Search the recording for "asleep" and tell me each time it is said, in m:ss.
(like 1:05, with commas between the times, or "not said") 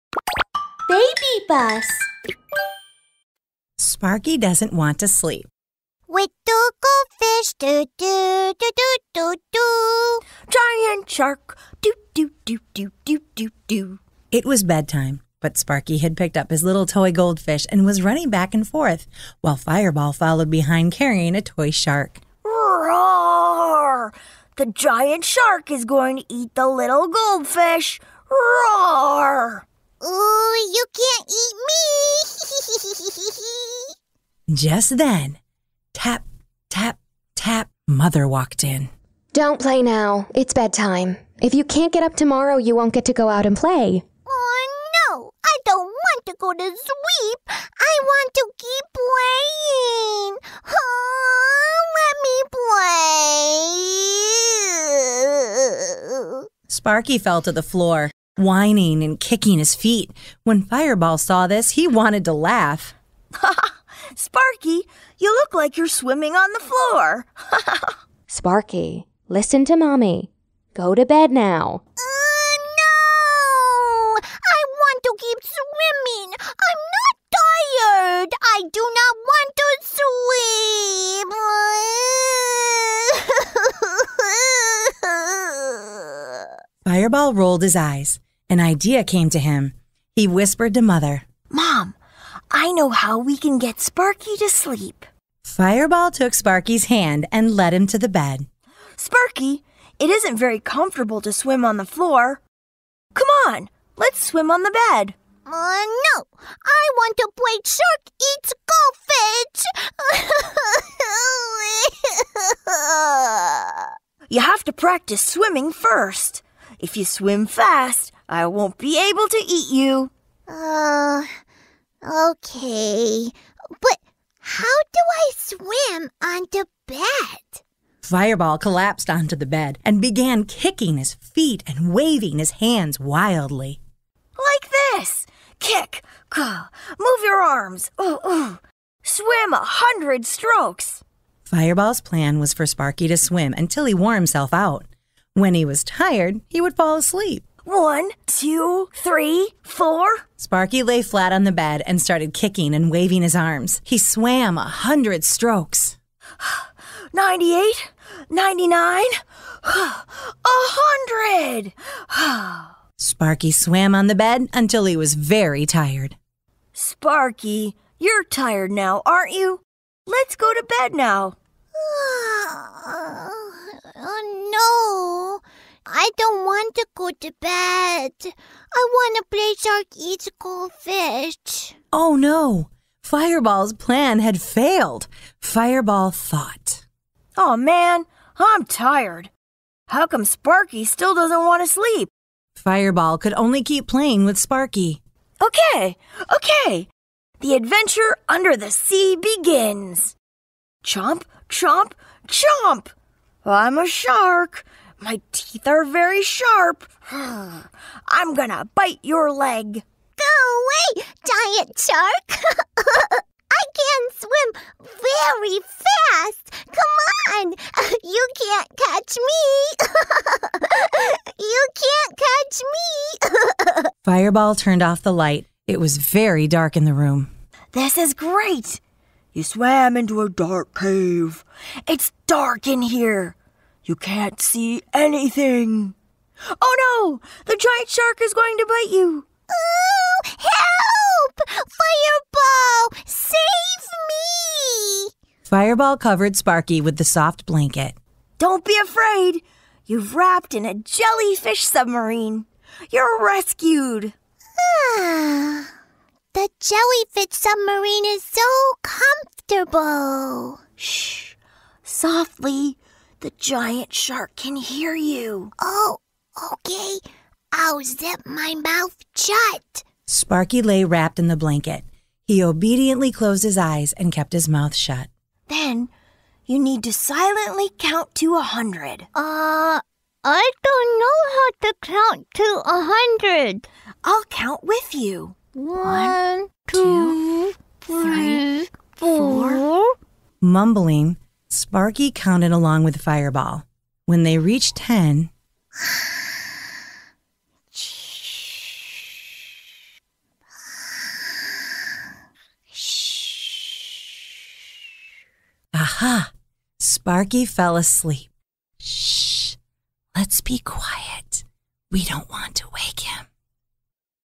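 2:26, 5:07.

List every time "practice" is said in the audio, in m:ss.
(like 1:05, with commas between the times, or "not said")
1:54.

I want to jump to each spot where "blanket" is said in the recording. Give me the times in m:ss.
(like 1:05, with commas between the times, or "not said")
4:07, 4:31.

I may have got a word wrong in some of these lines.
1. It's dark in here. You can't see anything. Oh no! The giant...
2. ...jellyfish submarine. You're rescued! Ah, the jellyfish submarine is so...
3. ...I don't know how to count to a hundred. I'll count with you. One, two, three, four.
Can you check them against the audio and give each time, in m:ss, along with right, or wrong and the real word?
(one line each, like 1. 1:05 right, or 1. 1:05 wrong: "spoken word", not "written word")
1. 3:51 right
2. 4:10 right
3. 4:40 right.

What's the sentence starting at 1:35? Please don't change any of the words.
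Fireball took Sparky's hand and led him to the bed.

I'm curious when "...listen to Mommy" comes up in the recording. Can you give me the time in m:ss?
1:09.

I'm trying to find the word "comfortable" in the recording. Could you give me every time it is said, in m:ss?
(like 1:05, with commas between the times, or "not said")
1:40, 4:18.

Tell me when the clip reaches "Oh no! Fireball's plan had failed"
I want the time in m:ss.
3:01.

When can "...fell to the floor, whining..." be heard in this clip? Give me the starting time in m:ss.
0:57.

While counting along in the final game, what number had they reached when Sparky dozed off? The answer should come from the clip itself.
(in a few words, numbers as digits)
10.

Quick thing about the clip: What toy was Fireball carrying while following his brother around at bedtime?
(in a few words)
toy shark.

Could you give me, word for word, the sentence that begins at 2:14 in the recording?
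Like this kick, move your arms, ooh, ooh.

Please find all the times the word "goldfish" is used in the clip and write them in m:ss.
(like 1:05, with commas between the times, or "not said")
0:06, 0:17, 0:27, 1:49, 3:00.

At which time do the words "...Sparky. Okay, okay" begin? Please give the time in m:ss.
3:14.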